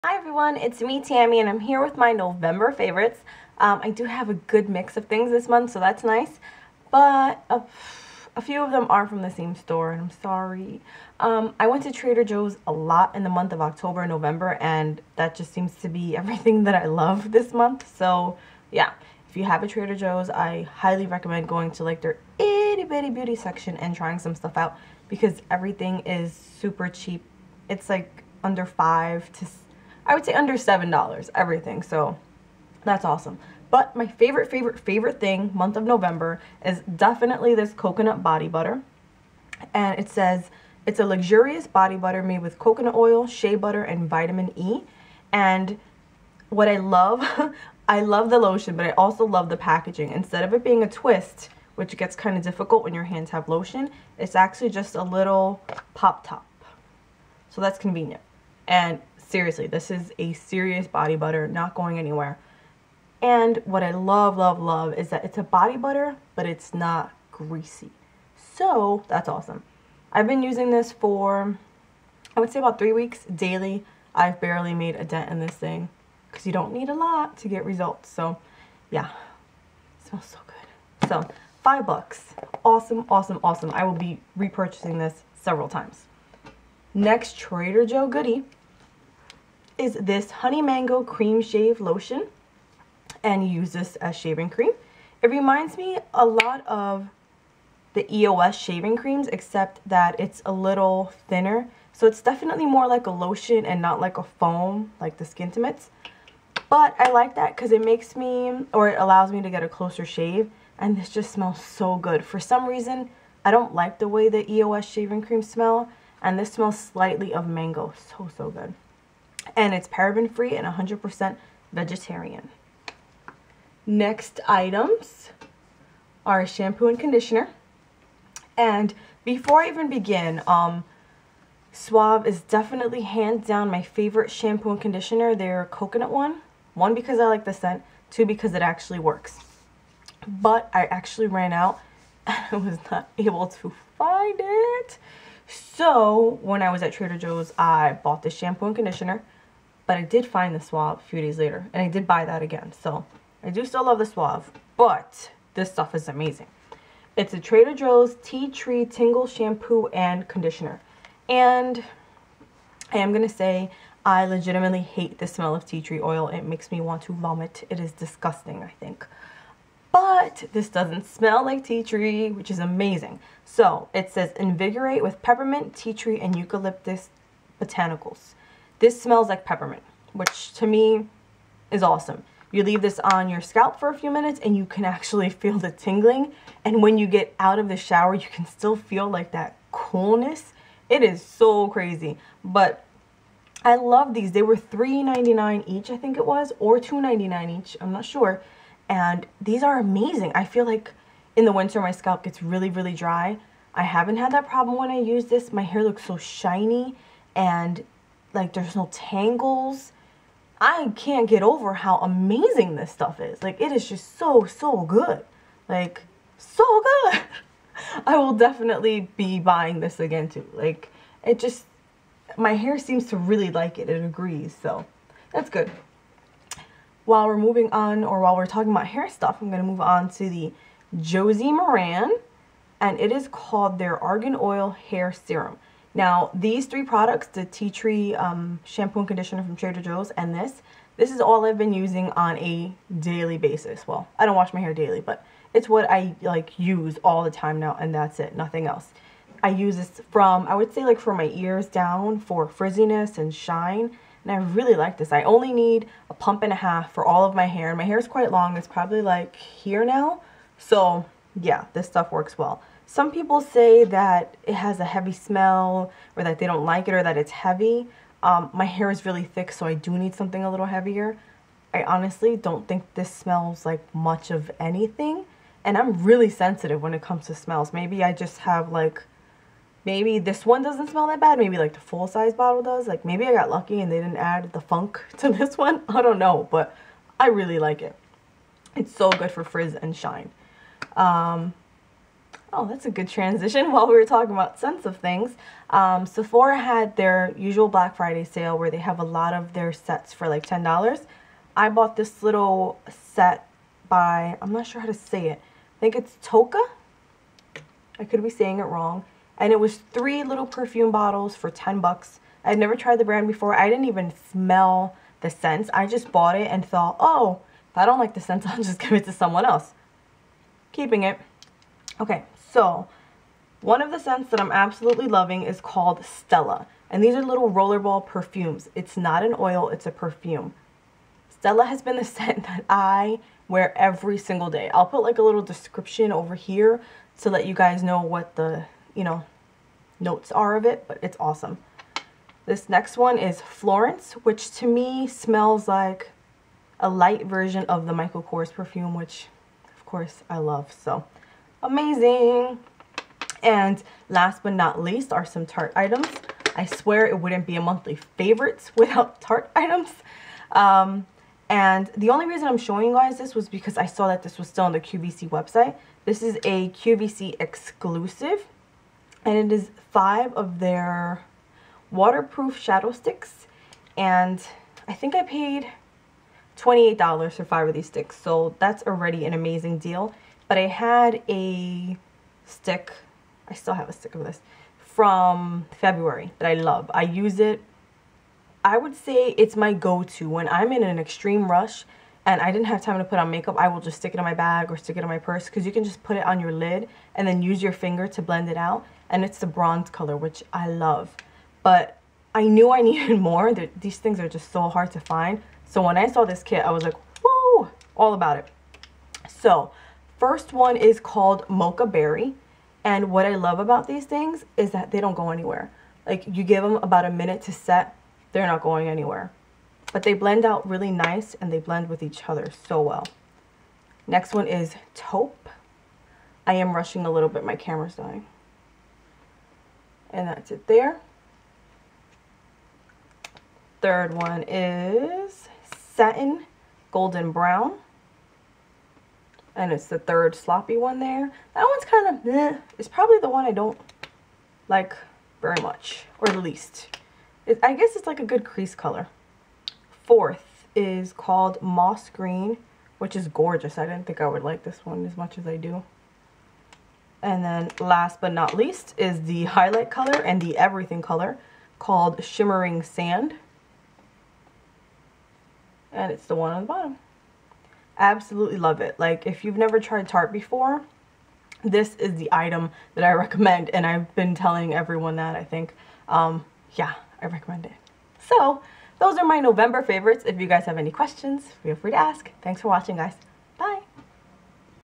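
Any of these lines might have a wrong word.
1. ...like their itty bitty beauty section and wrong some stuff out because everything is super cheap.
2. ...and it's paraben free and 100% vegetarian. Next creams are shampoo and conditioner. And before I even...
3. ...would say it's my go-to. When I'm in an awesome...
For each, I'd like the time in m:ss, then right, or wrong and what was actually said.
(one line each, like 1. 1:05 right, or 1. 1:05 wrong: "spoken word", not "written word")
1. 0:21 wrong: "trying", not "wrong"
2. 1:59 wrong: "items", not "creams"
3. 6:28 wrong: "extreme", not "awesome".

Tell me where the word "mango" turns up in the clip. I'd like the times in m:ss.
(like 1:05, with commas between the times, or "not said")
1:30, 1:57.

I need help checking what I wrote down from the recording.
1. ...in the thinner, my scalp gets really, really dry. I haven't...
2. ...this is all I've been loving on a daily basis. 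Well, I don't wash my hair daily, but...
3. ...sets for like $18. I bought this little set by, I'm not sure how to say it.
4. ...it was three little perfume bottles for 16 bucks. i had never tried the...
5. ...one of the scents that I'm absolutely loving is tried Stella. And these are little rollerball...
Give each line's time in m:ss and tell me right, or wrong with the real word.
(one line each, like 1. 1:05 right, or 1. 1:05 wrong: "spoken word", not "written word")
1. 3:21 wrong: "winter", not "thinner"
2. 4:00 wrong: "using", not "loving"
3. 4:59 wrong: "10", not "18"
4. 5:09 wrong: "10", not "16"
5. 5:23 wrong: "called", not "tried".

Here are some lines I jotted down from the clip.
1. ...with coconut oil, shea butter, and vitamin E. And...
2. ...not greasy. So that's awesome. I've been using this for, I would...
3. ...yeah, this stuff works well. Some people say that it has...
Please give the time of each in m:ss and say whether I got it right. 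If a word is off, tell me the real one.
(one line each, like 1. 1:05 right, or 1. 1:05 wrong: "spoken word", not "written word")
1. 0:42 right
2. 1:06 right
3. 4:21 right.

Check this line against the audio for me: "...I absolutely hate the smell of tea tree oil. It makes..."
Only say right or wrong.
wrong.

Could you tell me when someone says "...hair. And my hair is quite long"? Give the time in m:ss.
4:17.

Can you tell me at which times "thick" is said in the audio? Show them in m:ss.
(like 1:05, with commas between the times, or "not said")
4:29.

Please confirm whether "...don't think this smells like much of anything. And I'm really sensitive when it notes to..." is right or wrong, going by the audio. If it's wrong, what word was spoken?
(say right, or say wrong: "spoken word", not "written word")
wrong: "comes", not "notes".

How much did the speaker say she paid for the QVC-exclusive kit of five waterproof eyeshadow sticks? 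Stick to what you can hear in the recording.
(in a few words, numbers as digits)
$28.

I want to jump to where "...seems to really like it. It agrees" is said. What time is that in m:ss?
3:42.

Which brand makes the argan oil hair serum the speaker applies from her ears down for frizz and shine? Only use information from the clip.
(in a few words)
Josie Maran.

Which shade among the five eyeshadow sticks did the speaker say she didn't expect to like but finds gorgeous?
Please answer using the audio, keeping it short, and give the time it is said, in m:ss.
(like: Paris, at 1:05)
Moss Green, at 7:31.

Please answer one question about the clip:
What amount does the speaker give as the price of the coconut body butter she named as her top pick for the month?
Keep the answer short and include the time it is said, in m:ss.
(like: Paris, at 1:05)
5 bucks, at 1:21.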